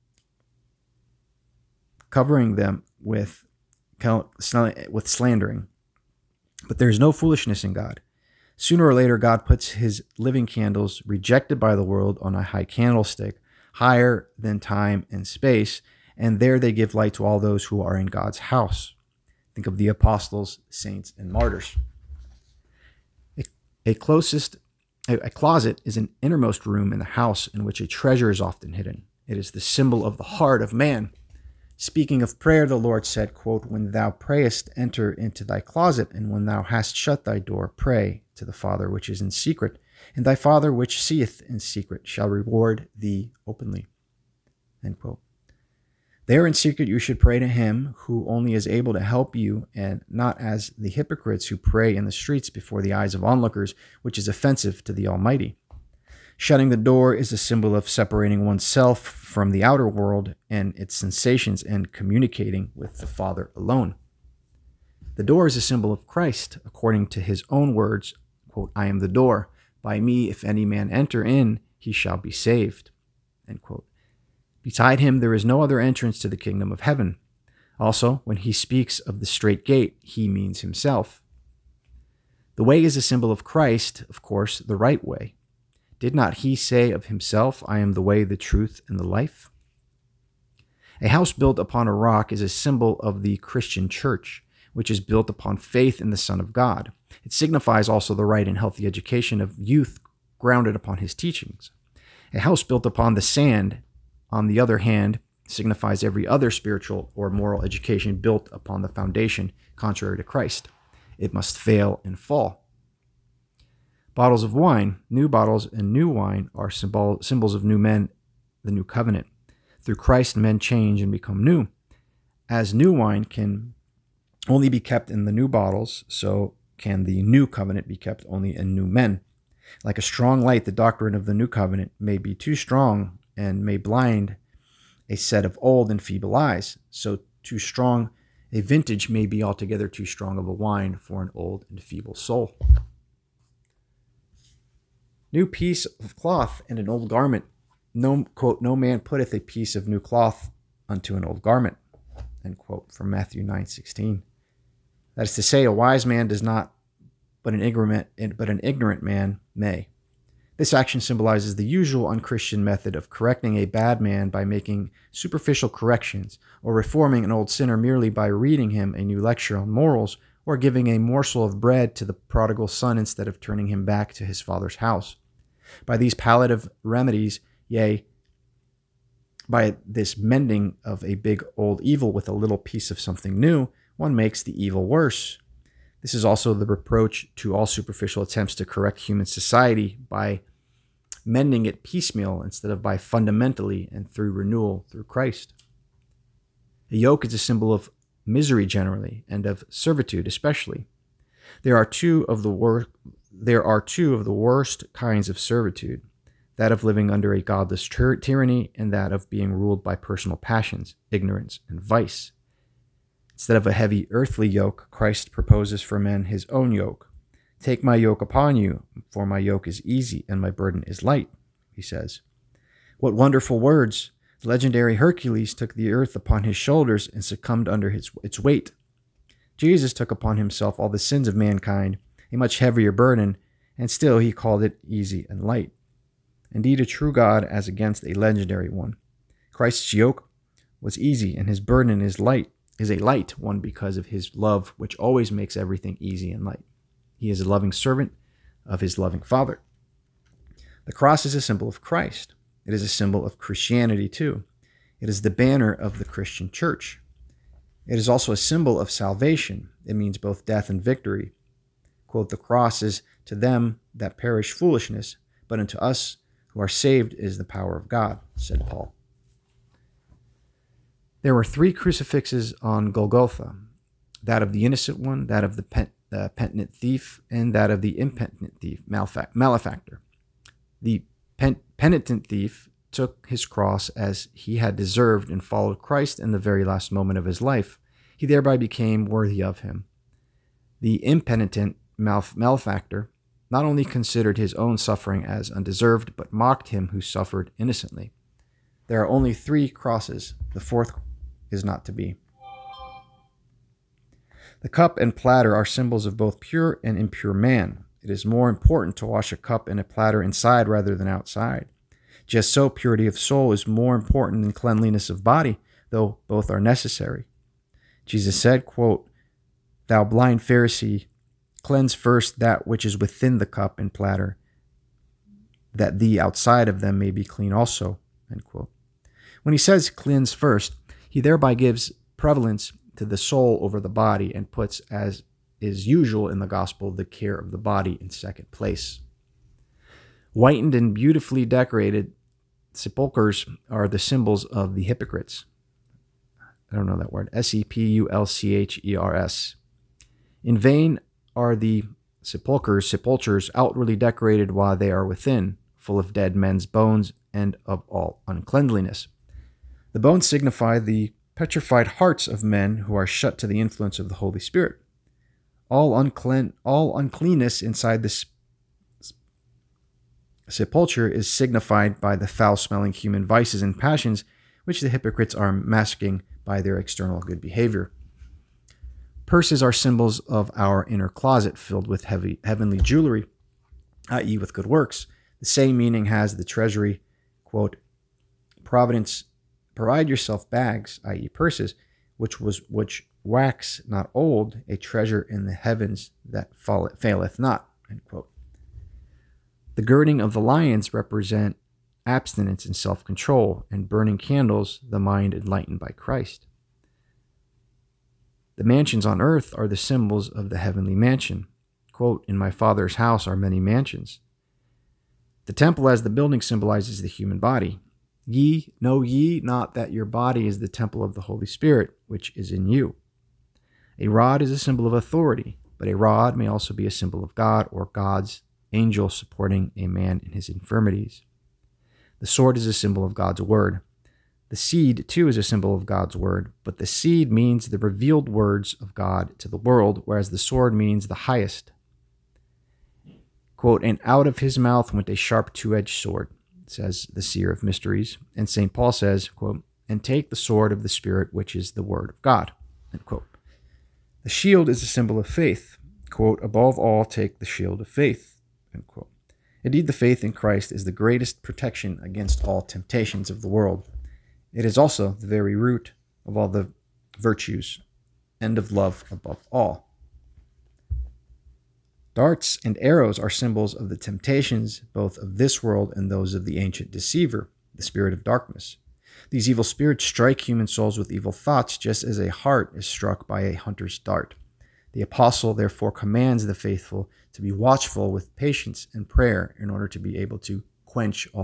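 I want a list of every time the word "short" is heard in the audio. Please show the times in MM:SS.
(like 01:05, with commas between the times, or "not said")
not said.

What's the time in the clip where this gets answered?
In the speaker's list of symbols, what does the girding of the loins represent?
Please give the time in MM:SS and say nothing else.
06:42.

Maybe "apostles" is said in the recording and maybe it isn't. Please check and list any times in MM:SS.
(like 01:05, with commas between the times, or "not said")
00:19, 08:05.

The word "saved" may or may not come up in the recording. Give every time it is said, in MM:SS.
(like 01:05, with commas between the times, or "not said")
01:12, 04:26.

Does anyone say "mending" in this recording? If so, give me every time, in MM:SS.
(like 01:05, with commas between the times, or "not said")
03:00, 03:11.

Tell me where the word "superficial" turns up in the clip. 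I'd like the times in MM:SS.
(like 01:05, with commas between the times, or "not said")
02:45, 03:07.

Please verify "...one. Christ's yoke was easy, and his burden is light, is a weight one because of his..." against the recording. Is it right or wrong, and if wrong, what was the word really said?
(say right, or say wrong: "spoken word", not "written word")
wrong: "light", not "weight".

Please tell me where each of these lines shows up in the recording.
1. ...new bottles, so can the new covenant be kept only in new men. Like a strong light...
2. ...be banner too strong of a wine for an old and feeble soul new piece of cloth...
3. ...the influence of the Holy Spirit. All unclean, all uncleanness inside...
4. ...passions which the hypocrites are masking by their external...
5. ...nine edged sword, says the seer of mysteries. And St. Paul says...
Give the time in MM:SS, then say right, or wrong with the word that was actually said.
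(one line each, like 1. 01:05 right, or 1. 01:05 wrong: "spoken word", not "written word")
1. 02:05 right
2. 02:19 wrong: "altogether", not "banner"
3. 06:03 right
4. 06:13 right
5. 07:25 wrong: "two", not "nine".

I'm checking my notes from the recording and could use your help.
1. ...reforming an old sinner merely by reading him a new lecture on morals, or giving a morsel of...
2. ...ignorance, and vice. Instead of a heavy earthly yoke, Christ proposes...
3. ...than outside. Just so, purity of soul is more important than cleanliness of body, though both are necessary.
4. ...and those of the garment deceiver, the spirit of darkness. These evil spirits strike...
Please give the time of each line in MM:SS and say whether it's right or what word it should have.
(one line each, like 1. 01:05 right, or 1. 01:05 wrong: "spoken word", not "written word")
1. 02:46 right
2. 03:31 right
3. 05:10 right
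4. 07:55 wrong: "ancient", not "garment".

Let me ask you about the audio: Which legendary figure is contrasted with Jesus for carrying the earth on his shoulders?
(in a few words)
Hercules.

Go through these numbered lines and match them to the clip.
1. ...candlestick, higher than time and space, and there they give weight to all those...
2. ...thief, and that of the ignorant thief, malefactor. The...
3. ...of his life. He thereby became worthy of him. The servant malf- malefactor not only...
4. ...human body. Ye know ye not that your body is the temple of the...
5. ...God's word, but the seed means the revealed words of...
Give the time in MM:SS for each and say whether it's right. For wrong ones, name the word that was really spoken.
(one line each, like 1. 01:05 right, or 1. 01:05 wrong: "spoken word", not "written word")
1. 00:12 wrong: "light", not "weight"
2. 04:36 wrong: "impenitent", not "ignorant"
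3. 04:47 wrong: "impenitent", not "servant"
4. 06:57 right
5. 07:15 right.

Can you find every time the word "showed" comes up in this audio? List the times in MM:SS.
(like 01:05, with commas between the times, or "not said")
not said.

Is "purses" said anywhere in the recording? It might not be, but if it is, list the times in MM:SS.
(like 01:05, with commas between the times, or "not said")
06:19, 06:31.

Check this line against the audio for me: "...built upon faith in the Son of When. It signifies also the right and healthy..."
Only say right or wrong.
wrong.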